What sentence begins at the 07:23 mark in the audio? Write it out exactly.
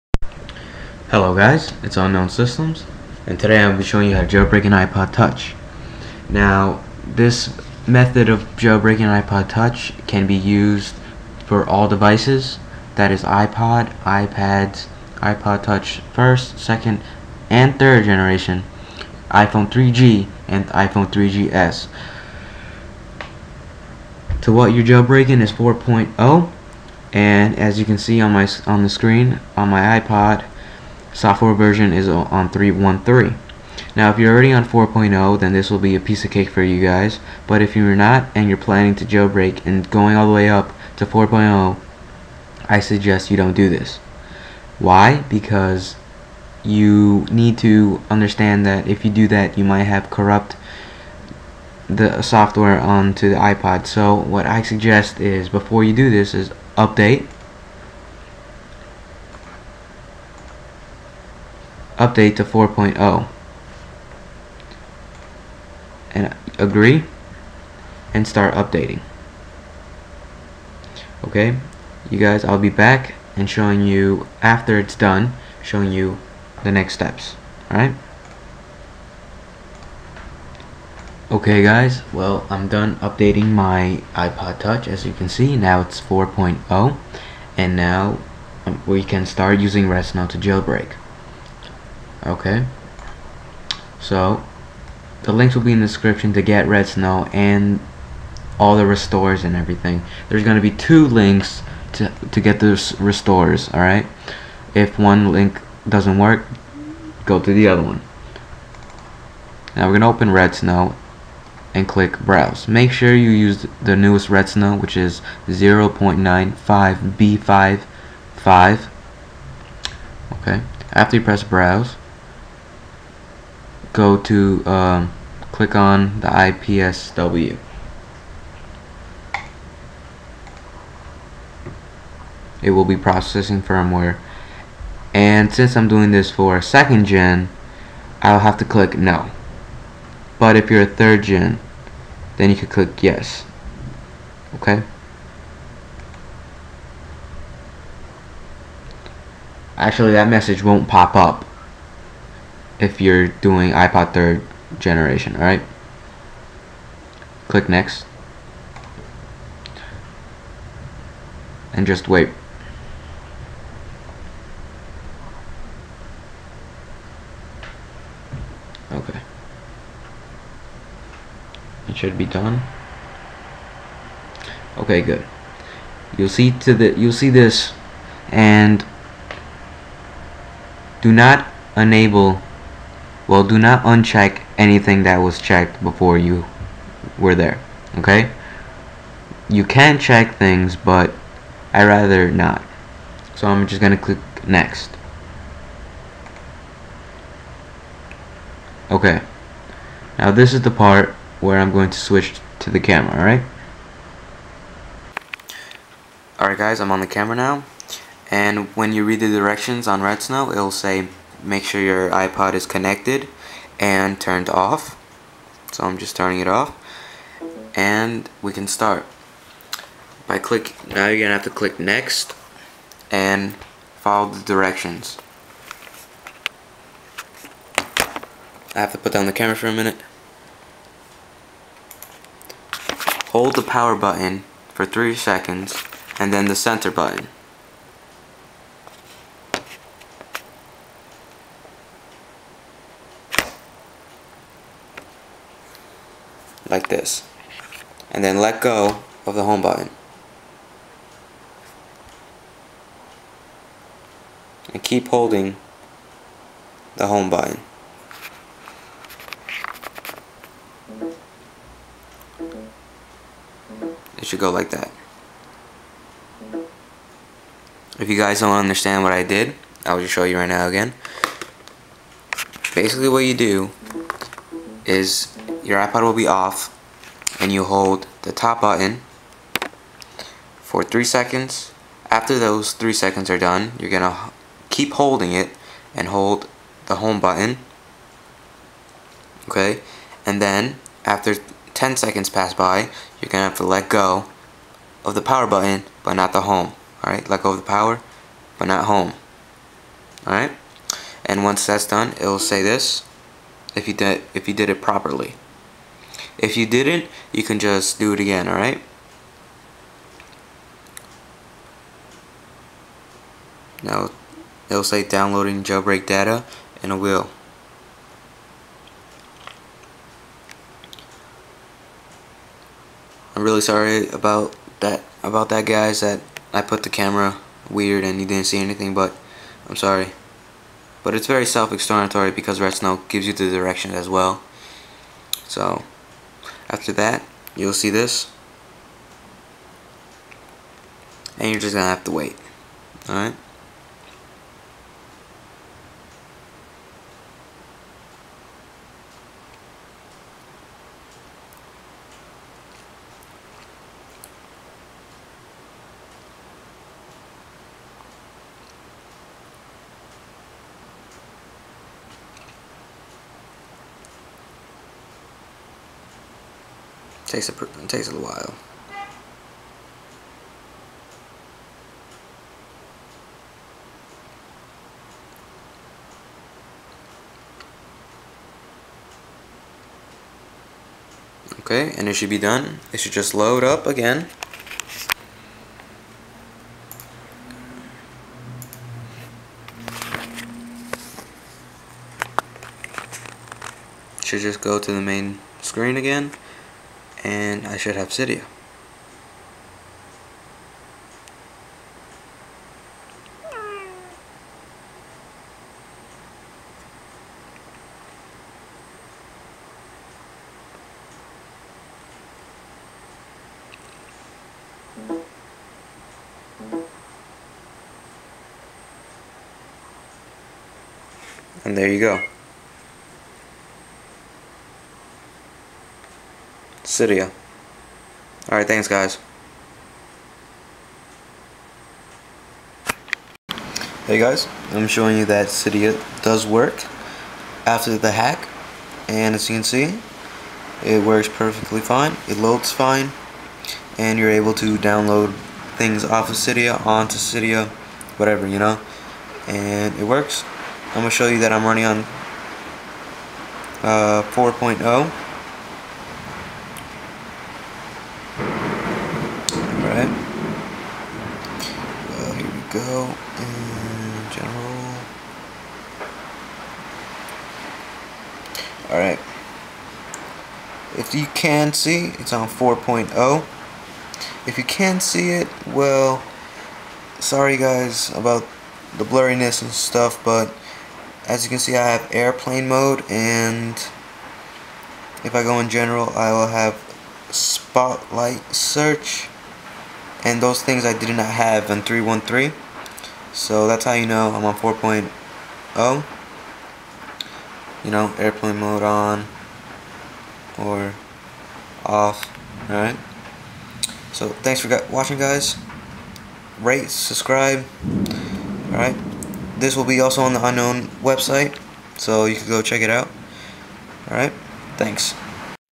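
And you're able to download things off of Cydia onto Cydia, whatever, you know.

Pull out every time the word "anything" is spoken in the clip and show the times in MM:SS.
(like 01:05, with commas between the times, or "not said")
03:04, 05:28.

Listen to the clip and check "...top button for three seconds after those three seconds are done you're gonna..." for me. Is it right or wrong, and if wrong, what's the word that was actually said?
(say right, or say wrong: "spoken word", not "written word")
right.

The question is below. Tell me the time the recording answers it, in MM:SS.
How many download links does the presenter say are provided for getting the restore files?
01:40.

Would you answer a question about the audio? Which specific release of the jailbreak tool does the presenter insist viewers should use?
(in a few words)
0.95b55.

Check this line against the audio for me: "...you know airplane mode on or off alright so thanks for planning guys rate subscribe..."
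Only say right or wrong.
wrong.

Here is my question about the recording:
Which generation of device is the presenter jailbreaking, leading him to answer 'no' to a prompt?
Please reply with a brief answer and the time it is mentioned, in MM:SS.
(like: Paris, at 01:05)
second gen, at 02:16.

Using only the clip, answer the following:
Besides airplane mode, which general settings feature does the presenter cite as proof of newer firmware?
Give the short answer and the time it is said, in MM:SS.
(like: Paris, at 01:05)
spotlight search, at 08:07.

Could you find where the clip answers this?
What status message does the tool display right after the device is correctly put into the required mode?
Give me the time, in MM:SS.
05:15.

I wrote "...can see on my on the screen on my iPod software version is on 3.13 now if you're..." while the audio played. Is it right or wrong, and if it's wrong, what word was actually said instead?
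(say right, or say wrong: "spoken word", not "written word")
right.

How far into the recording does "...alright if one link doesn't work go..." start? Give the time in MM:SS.
01:43.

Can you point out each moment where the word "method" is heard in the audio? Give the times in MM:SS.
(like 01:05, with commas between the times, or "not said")
00:07.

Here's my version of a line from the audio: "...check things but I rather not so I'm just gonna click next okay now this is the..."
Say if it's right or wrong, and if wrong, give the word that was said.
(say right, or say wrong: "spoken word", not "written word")
right.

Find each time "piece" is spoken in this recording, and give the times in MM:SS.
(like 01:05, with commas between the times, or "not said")
00:35.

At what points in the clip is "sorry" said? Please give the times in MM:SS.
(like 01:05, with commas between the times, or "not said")
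05:23, 05:29, 07:57.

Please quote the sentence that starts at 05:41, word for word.
And you're just going to have to wait.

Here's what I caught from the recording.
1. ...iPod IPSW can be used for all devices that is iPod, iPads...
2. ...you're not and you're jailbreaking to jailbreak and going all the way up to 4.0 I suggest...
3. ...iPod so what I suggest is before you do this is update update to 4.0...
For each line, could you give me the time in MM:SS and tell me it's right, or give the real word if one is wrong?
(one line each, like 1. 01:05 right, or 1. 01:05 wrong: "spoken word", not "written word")
1. 00:09 wrong: "Touch", not "IPSW"
2. 00:37 wrong: "planning", not "jailbreaking"
3. 00:53 right.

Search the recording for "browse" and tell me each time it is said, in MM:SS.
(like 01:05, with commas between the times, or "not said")
01:52, 02:01.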